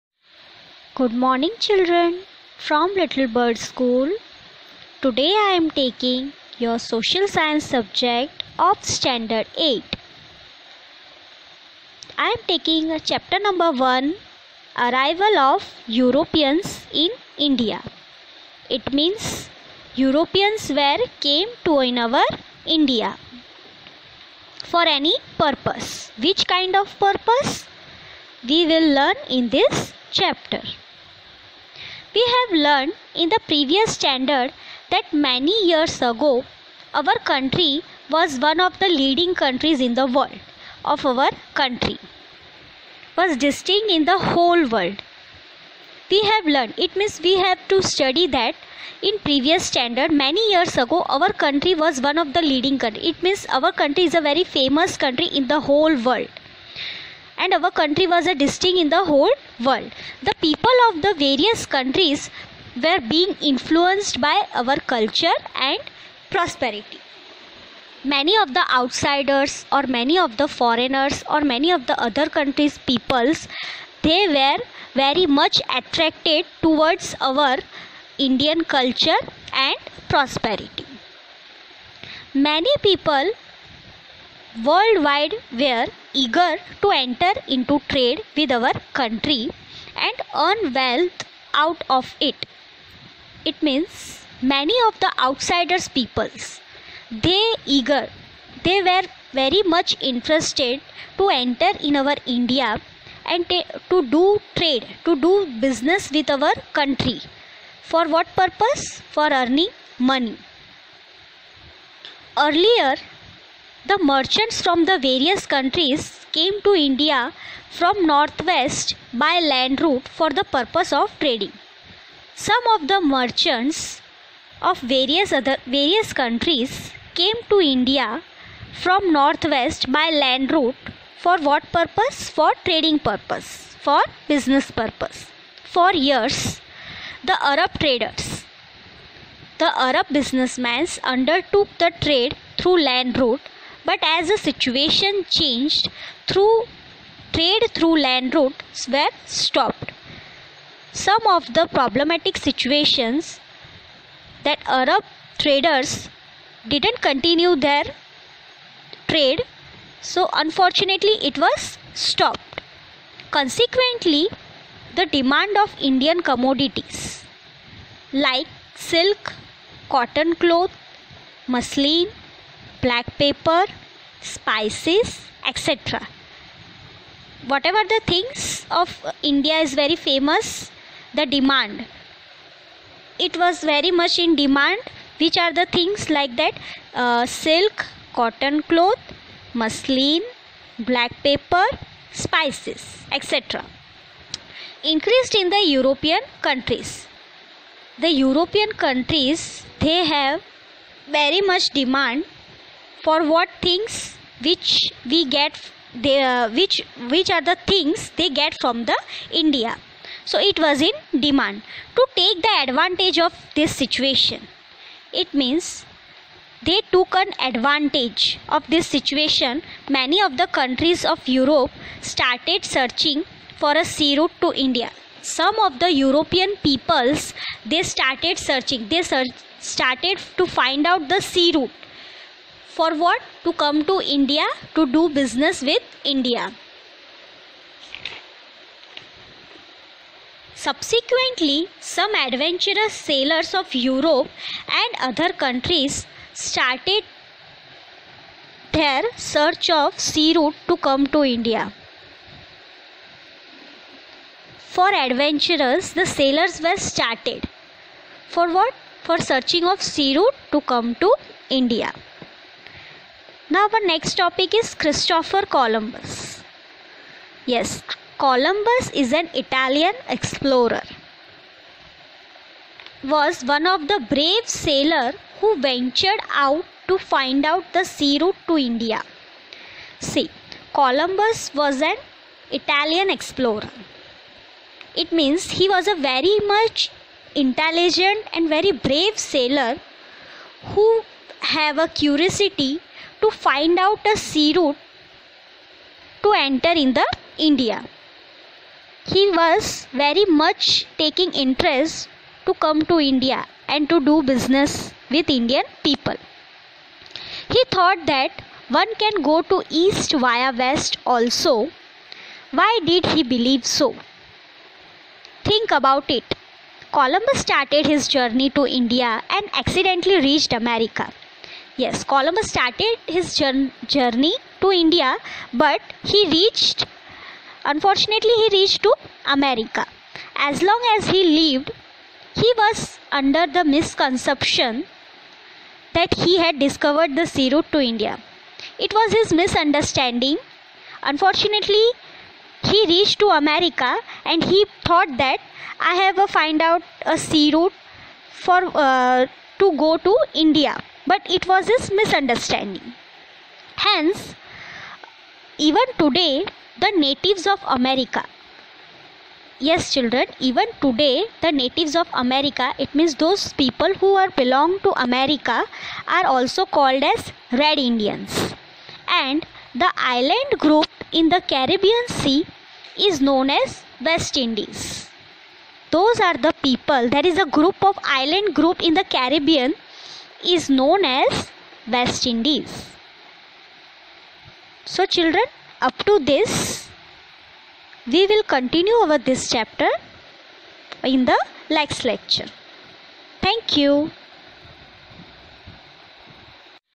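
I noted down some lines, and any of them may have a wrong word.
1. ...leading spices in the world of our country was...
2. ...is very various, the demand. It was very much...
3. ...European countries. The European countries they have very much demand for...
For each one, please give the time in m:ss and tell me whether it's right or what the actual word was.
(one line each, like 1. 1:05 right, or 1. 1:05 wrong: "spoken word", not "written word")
1. 0:38 wrong: "countries", not "spices"
2. 2:59 wrong: "famous", not "various"
3. 3:15 right.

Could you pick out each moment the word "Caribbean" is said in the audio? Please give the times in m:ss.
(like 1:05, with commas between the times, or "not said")
6:11, 6:19.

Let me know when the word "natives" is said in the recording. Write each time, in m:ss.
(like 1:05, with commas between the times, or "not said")
5:56, 6:01.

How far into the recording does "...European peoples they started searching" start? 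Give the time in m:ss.
3:45.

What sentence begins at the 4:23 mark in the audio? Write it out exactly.
Now our next topic is Christopher Columbus.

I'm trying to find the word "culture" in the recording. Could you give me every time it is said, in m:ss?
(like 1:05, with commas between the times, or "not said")
1:04, 1:18.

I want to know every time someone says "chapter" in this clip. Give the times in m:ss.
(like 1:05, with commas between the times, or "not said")
0:13, 0:30, 6:29.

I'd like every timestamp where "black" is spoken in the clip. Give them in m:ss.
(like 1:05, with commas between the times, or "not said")
2:52, 3:10.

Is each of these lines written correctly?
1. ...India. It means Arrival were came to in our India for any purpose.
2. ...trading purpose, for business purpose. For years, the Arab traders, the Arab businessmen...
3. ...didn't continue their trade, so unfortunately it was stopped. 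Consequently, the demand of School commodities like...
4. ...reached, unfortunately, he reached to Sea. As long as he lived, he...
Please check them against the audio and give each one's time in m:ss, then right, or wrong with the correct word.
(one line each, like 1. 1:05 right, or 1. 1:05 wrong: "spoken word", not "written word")
1. 0:17 wrong: "Europeans", not "Arrival"
2. 2:12 right
3. 2:36 wrong: "Indian", not "School"
4. 5:26 wrong: "America", not "Sea".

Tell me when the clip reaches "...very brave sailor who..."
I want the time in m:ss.
4:48.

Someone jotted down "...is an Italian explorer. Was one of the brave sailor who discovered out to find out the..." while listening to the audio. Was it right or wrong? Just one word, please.
wrong.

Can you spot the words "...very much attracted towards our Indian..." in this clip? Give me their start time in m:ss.
1:14.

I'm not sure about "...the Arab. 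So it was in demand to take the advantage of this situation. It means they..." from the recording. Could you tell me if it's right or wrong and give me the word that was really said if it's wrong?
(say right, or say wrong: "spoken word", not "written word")
wrong: "India", not "Arab".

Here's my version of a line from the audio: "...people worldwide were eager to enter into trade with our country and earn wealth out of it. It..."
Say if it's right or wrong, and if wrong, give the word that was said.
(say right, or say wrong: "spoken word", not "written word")
right.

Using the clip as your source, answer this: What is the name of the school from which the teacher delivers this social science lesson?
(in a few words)
Little Bird School.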